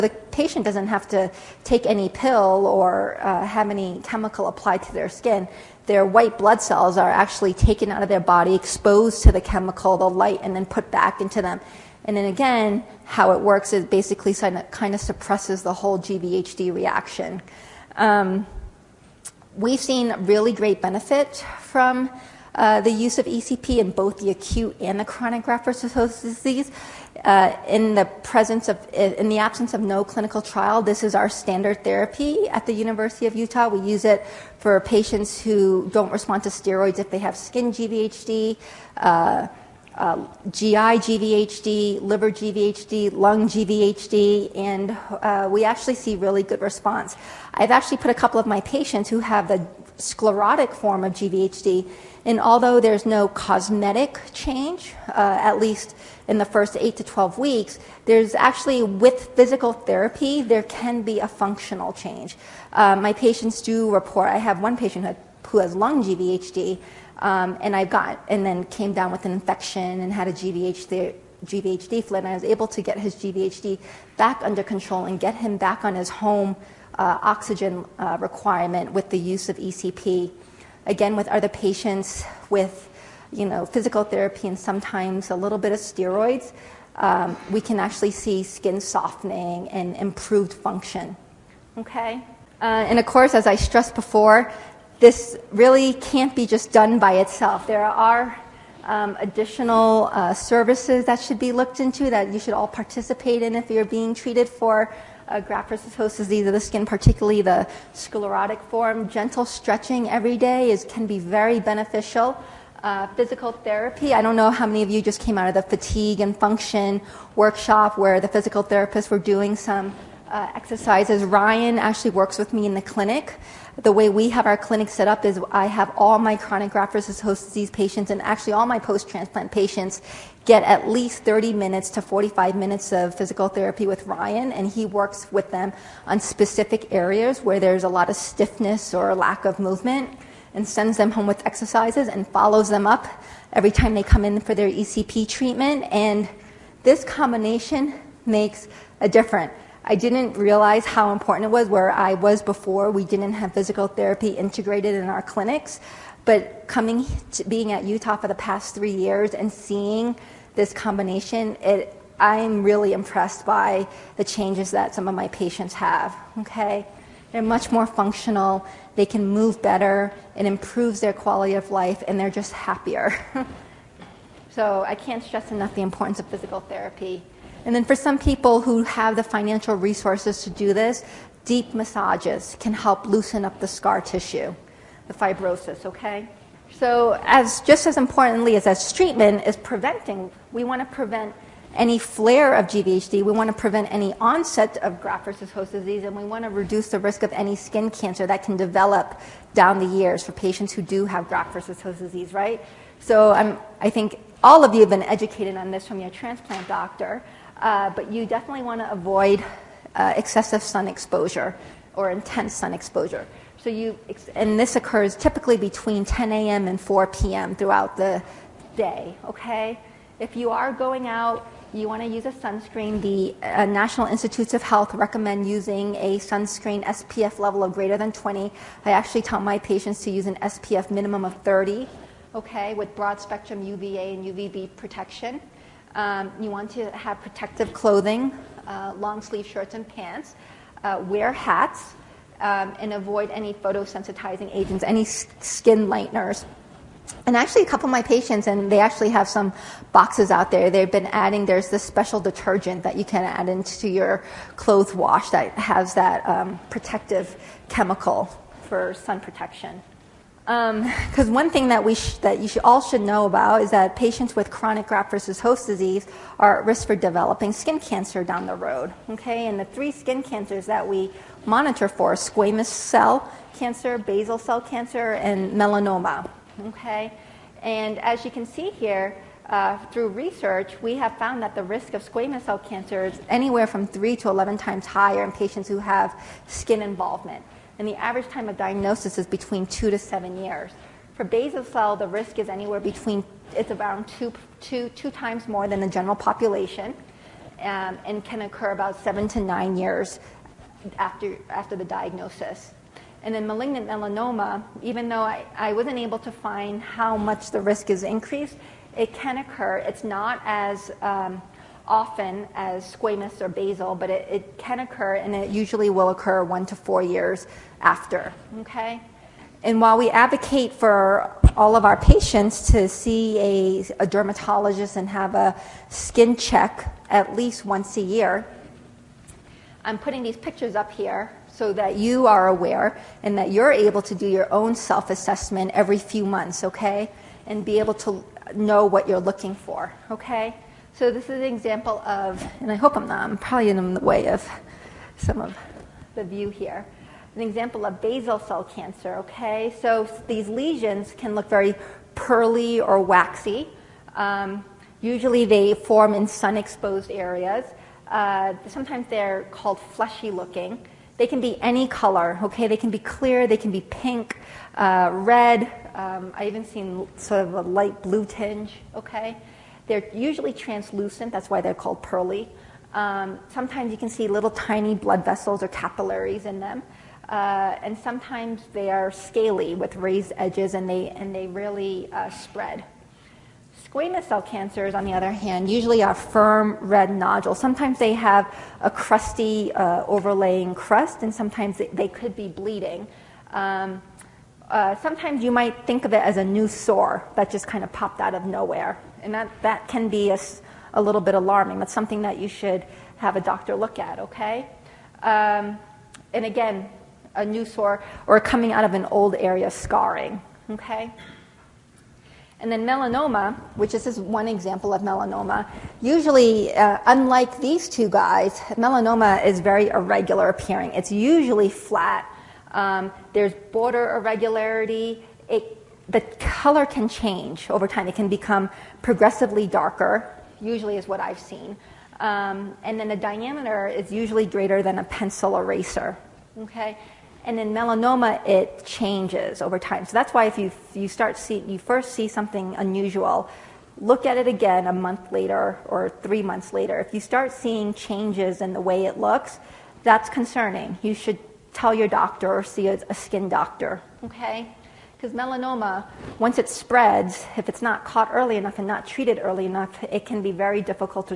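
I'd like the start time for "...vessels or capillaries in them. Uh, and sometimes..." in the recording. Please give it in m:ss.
6:15.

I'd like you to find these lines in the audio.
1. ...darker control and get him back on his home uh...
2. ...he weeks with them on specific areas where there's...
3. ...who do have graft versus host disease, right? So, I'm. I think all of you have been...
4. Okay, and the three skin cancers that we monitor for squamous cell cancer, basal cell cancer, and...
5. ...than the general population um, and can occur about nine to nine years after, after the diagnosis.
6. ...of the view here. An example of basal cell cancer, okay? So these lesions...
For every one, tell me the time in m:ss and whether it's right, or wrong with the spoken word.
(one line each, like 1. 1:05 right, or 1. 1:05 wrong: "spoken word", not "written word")
1. 1:14 wrong: "under", not "darker"
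2. 2:14 wrong: "works", not "weeks"
3. 3:20 right
4. 4:29 right
5. 4:55 wrong: "seven", not "nine"
6. 5:45 right.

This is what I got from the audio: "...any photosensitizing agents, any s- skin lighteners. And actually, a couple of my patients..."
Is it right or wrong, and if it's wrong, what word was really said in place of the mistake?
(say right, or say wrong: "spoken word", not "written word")
right.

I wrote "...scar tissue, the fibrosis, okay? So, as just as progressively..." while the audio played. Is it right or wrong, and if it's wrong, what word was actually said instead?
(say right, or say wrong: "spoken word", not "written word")
wrong: "importantly", not "progressively".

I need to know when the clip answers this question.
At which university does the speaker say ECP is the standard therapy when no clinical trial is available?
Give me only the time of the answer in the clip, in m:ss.
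0:32.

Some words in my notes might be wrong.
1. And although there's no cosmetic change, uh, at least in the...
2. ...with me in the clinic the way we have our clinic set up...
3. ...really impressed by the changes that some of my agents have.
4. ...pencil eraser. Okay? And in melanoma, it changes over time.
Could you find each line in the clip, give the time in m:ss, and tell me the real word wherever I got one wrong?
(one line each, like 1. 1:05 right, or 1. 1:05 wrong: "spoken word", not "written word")
1. 0:52 right
2. 2:02 right
3. 2:42 wrong: "patients", not "agents"
4. 7:15 right.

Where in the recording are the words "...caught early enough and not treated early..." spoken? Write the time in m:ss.
7:38.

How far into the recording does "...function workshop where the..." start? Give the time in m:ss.
1:56.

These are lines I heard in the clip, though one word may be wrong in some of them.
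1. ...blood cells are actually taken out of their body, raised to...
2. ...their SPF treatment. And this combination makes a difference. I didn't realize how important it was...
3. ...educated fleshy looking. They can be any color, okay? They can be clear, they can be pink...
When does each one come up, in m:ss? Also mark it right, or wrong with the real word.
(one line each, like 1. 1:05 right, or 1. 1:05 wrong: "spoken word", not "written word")
1. 0:06 wrong: "exposed", not "raised"
2. 2:24 wrong: "ECP", not "SPF"
3. 5:59 wrong: "called", not "educated".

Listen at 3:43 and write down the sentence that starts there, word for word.
The uh, National Institutes of Health recommend using a sunscreen SPF level of greater than 20.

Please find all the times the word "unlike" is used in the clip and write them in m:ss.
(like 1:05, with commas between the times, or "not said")
6:57.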